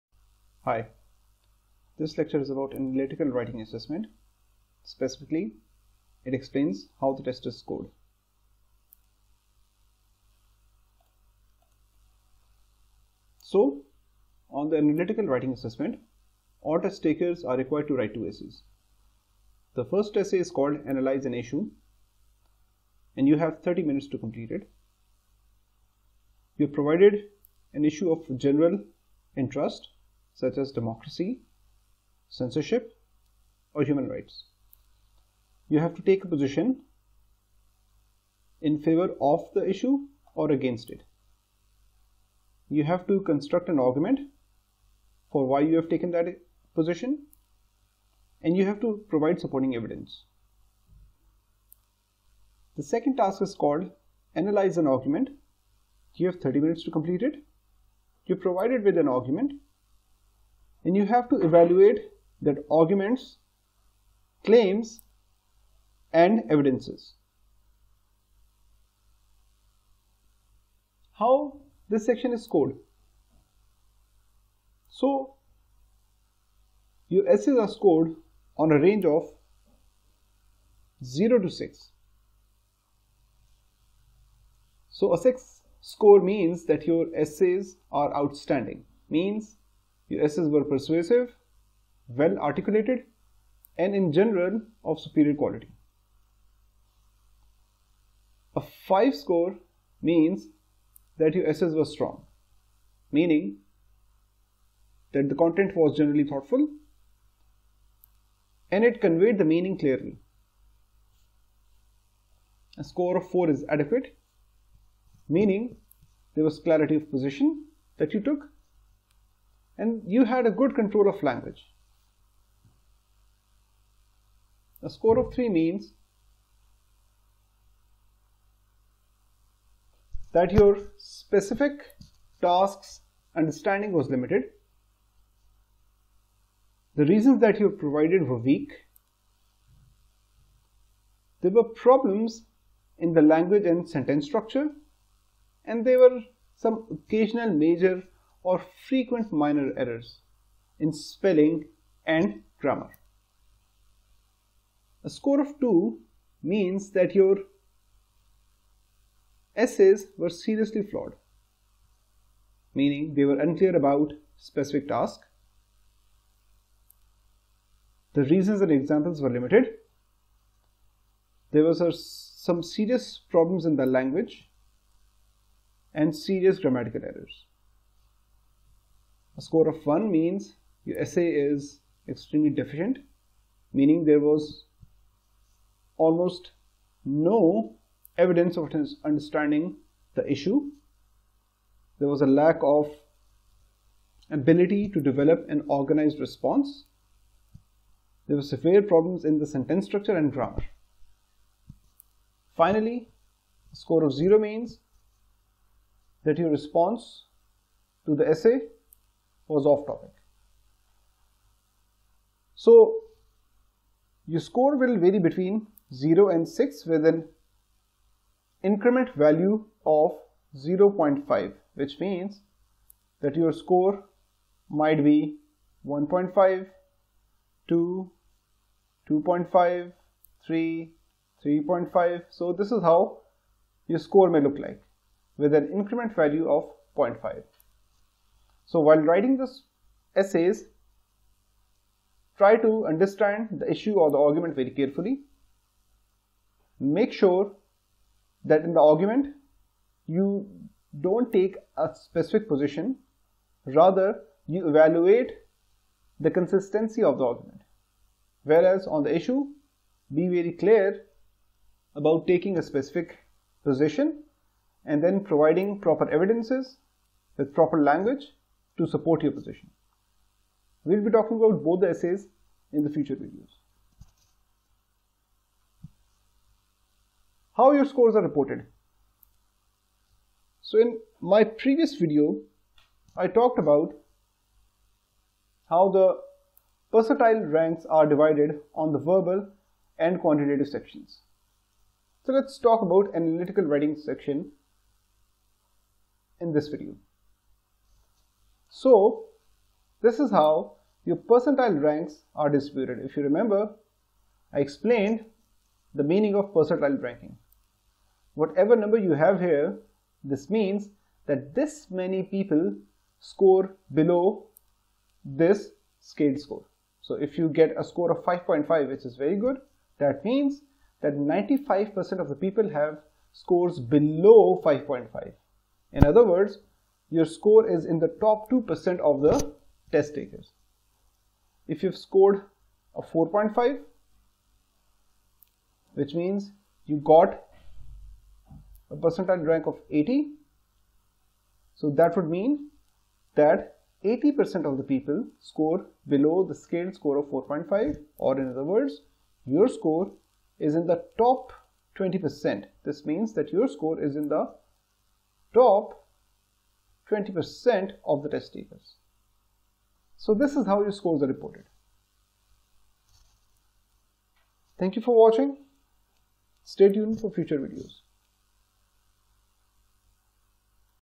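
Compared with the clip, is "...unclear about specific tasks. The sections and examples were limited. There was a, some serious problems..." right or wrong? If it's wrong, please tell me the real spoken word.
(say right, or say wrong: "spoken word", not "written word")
wrong: "reasons", not "sections".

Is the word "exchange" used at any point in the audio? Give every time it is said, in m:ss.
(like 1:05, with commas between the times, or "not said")
not said.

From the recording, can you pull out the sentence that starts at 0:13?
So, on the analytical writing assessment, all test takers are required to write two essays.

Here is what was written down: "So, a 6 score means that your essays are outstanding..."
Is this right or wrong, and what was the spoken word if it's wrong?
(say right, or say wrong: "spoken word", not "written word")
right.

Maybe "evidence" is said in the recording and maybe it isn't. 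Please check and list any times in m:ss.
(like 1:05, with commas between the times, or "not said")
0:49, 1:06, 3:08, 4:26.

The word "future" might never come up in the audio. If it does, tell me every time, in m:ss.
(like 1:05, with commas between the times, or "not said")
4:32, 6:07.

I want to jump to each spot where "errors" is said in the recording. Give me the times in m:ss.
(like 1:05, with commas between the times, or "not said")
2:29, 2:57.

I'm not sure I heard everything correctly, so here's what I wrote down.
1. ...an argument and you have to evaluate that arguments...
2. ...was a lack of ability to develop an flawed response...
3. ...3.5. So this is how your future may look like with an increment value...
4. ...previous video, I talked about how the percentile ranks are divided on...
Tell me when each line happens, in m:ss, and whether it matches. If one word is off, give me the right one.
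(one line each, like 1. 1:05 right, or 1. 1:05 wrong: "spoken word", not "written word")
1. 0:58 right
2. 3:12 wrong: "organized", not "flawed"
3. 3:51 wrong: "score", not "future"
4. 4:41 right.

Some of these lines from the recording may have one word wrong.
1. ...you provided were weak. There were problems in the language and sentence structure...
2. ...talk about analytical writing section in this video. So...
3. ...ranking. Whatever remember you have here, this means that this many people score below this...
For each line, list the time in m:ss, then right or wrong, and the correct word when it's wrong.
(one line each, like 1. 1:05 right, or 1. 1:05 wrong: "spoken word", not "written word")
1. 2:17 right
2. 4:52 right
3. 5:07 wrong: "number", not "remember".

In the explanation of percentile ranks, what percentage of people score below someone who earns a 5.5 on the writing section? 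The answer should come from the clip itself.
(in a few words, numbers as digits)
95%.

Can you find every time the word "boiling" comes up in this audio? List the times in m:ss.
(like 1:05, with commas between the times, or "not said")
not said.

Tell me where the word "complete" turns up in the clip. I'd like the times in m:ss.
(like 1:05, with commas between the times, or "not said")
0:24, 0:56.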